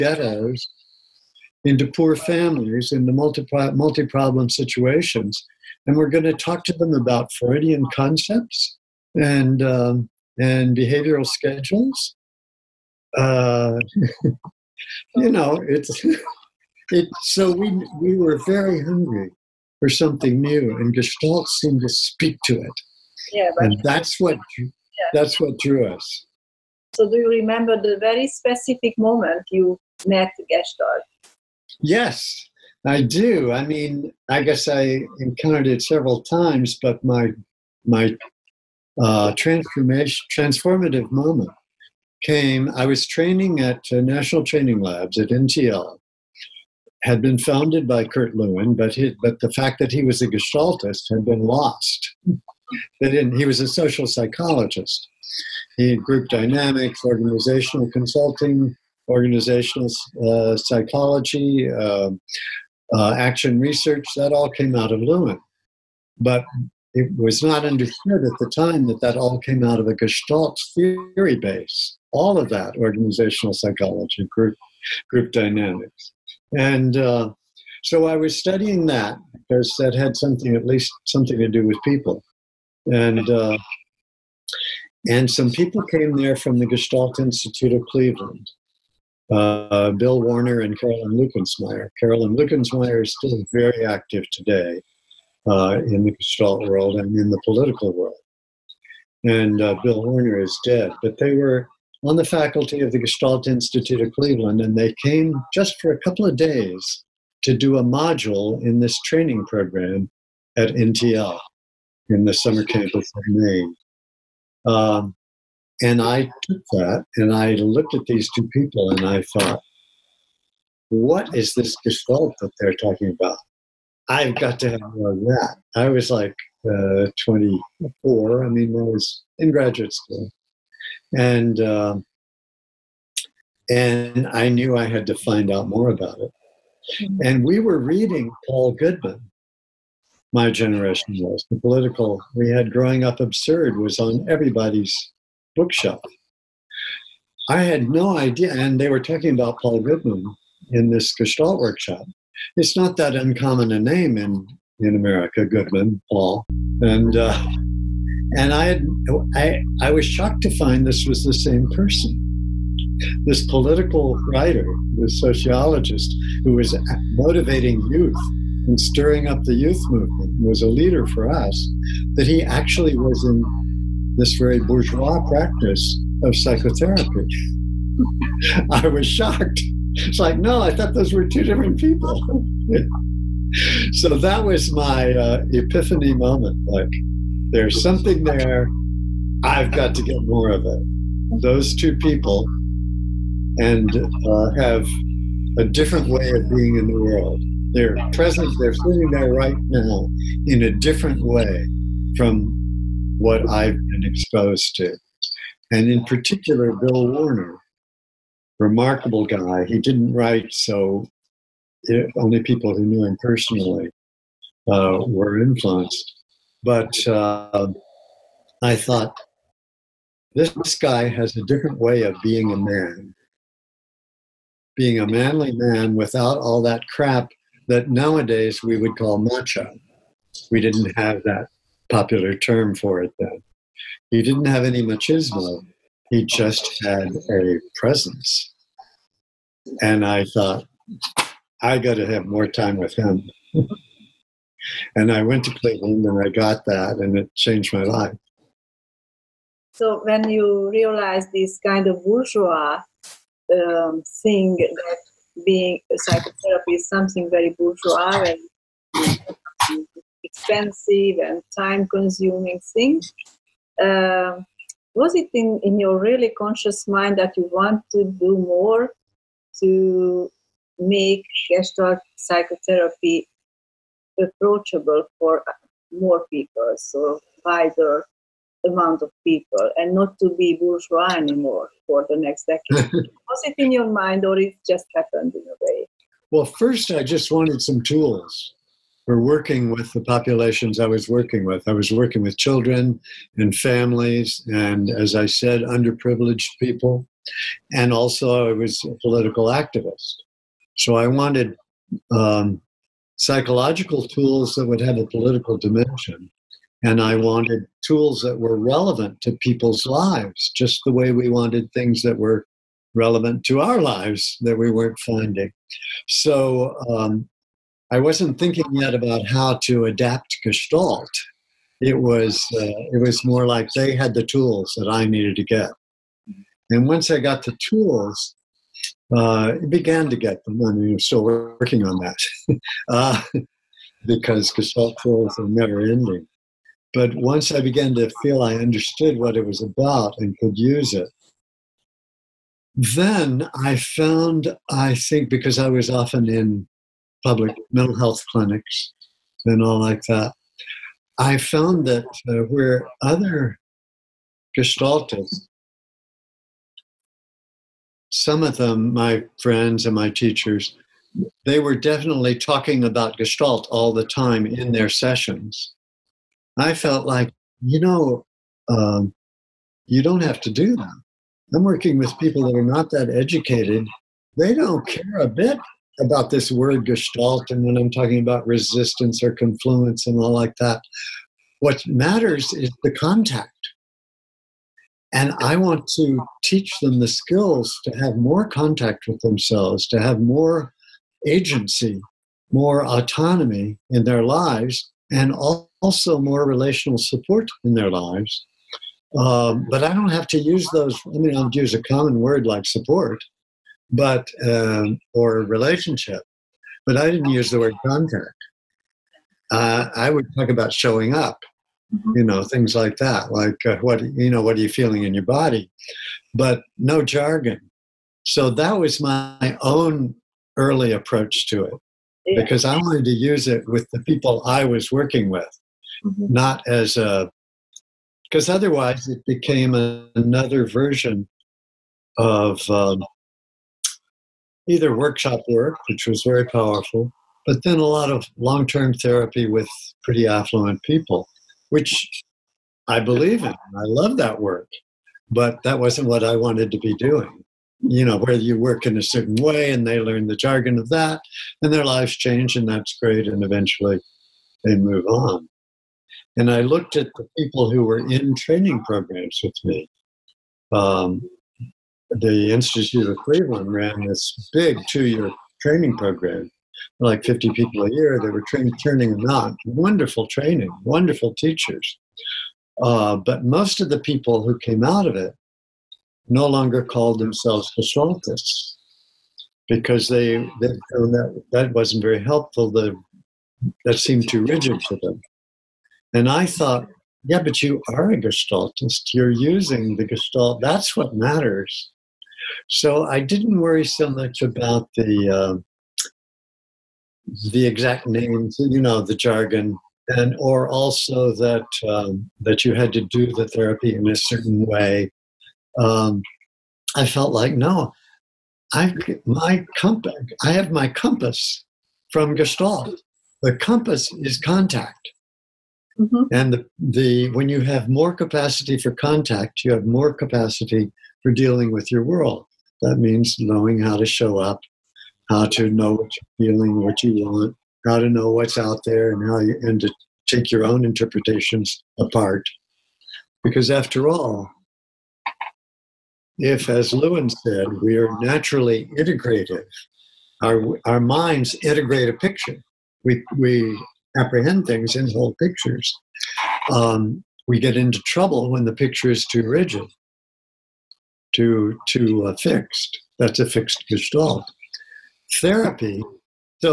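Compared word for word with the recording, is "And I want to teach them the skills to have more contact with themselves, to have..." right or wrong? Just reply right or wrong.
right.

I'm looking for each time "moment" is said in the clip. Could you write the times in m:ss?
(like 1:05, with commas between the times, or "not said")
0:28, 0:41, 3:06.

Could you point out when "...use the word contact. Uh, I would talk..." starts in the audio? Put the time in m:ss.
6:47.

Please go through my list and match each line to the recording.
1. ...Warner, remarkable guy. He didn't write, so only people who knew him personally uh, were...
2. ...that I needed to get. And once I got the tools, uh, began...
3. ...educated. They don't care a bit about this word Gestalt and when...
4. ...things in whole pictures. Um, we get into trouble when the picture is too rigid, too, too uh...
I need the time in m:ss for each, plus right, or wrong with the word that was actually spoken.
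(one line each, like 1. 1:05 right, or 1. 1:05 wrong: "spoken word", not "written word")
1. 3:27 right
2. 5:24 right
3. 6:13 right
4. 9:04 right.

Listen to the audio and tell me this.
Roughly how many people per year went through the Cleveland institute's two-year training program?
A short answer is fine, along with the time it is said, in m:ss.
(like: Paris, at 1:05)
50, at 7:47.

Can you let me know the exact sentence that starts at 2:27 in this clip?
I had no idea, and they were talking about Paul Goodman in this Gestalt workshop.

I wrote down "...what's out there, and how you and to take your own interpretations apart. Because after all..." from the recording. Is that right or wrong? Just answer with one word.
right.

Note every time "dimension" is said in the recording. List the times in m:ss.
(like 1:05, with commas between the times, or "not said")
5:05.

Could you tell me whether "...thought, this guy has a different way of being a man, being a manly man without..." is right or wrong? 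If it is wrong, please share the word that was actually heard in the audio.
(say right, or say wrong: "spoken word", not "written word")
right.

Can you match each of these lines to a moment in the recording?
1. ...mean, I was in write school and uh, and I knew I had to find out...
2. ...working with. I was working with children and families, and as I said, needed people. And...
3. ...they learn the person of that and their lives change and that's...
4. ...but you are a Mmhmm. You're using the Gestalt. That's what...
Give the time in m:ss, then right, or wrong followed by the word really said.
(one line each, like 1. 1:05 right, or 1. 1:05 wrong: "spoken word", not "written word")
1. 2:08 wrong: "graduate", not "write"
2. 4:51 wrong: "underprivileged", not "needed"
3. 7:29 wrong: "jargon", not "person"
4. 8:07 wrong: "Gestaltist", not "Mmhmm".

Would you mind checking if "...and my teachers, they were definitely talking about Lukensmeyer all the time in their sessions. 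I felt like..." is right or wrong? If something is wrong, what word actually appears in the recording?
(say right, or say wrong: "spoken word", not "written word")
wrong: "Gestalt", not "Lukensmeyer".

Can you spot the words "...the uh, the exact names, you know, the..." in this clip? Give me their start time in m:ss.
8:14.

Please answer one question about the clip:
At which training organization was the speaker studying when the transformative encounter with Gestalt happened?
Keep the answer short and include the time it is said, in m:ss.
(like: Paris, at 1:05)
National Training Labs, at 0:44.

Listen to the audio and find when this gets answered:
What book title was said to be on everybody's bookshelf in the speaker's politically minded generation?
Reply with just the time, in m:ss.
2:22.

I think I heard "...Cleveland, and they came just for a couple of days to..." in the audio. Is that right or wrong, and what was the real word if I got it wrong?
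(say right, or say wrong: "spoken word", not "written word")
right.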